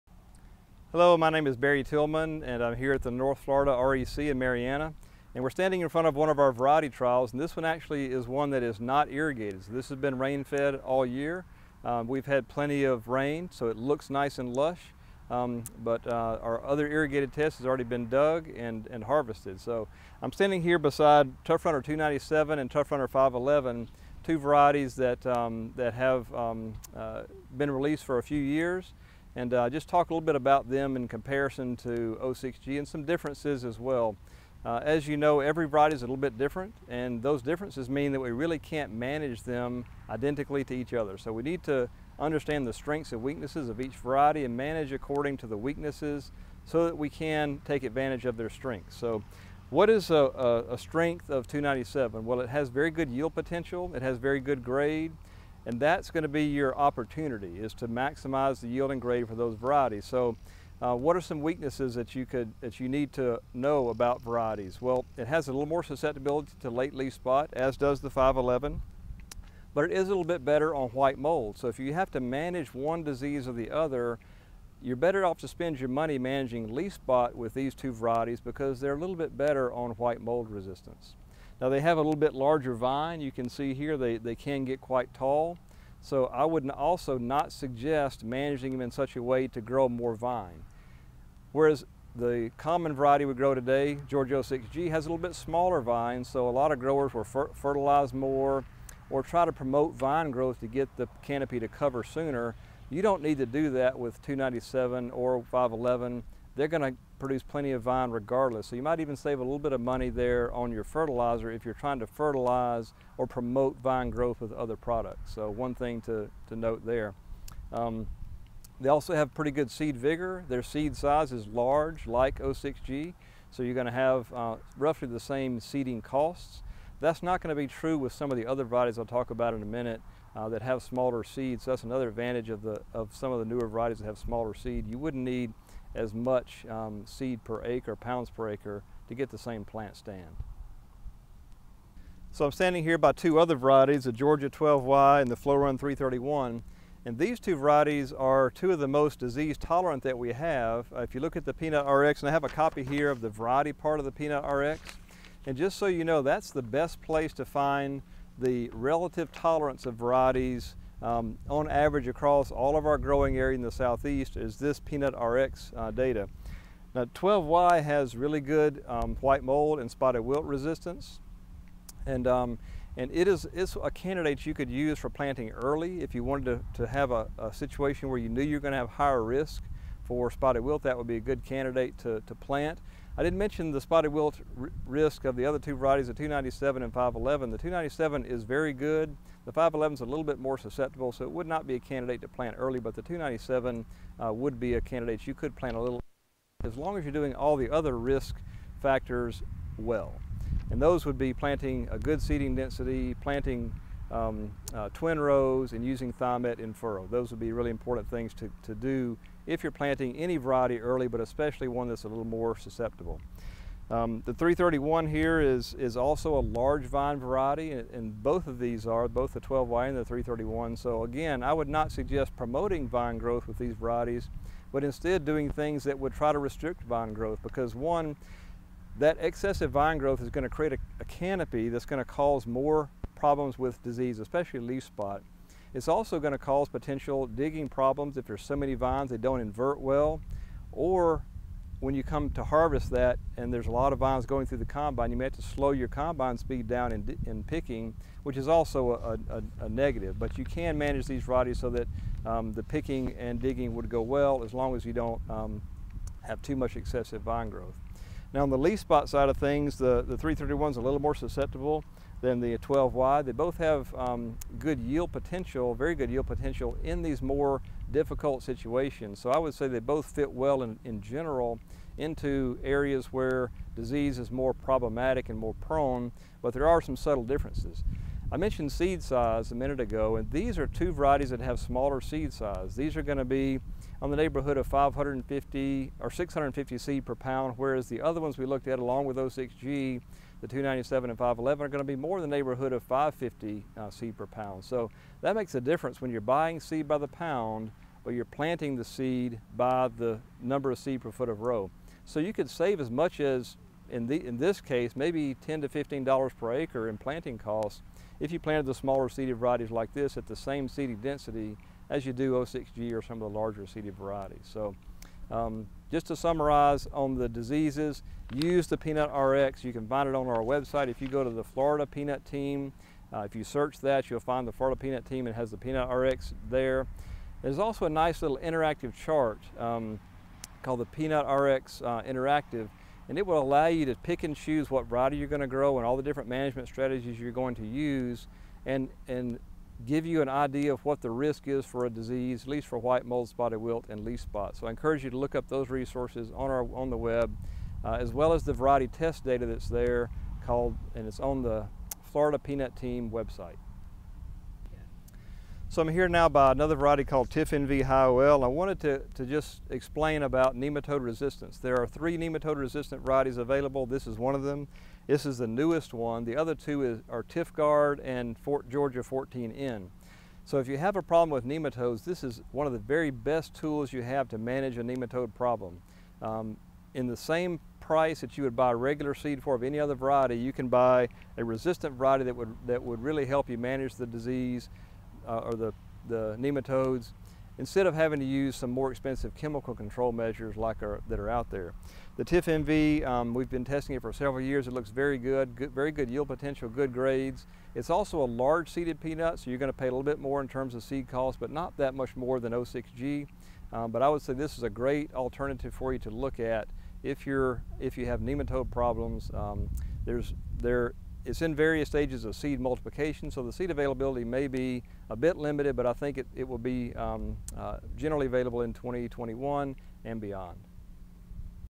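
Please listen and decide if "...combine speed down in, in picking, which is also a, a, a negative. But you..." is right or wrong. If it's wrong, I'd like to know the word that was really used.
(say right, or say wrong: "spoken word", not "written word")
right.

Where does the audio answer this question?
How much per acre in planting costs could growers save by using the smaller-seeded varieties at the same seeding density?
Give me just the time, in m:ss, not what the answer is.
5:05.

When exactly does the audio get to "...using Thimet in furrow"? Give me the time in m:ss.
3:25.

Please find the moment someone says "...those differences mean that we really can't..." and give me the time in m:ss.
0:37.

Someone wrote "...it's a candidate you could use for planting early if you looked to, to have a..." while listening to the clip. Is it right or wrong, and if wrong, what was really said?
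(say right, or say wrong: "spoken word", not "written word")
wrong: "wanted", not "looked".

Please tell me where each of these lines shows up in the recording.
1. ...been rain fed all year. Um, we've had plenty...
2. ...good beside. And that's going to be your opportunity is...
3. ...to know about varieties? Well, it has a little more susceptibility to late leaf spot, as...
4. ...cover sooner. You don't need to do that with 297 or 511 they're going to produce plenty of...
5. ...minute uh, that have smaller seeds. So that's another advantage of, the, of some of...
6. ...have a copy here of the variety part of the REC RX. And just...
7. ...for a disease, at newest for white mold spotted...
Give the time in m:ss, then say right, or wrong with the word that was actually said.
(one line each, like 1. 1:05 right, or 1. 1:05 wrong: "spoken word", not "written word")
1. 0:09 right
2. 0:54 wrong: "grade", not "beside"
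3. 1:03 right
4. 1:41 right
5. 2:09 right
6. 2:32 wrong: "Peanut", not "REC"
7. 5:41 wrong: "least", not "newest".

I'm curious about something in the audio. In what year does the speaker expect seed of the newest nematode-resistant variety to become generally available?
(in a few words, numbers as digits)
2021.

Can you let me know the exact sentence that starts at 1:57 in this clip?
Um, they also have pretty good seed vigor.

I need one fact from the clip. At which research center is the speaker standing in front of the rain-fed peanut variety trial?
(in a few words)
North Florida REC.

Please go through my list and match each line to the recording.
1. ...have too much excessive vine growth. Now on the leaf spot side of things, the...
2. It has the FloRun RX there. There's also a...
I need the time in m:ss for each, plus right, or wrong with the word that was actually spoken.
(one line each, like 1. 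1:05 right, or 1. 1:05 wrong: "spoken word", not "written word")
1. 4:16 right
2. 5:25 wrong: "Peanut", not "FloRun".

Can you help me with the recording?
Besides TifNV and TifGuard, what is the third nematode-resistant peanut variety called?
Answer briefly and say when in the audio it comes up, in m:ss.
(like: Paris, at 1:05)
Georgia 14N, at 6:08.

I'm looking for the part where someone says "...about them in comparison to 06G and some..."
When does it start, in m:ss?
0:30.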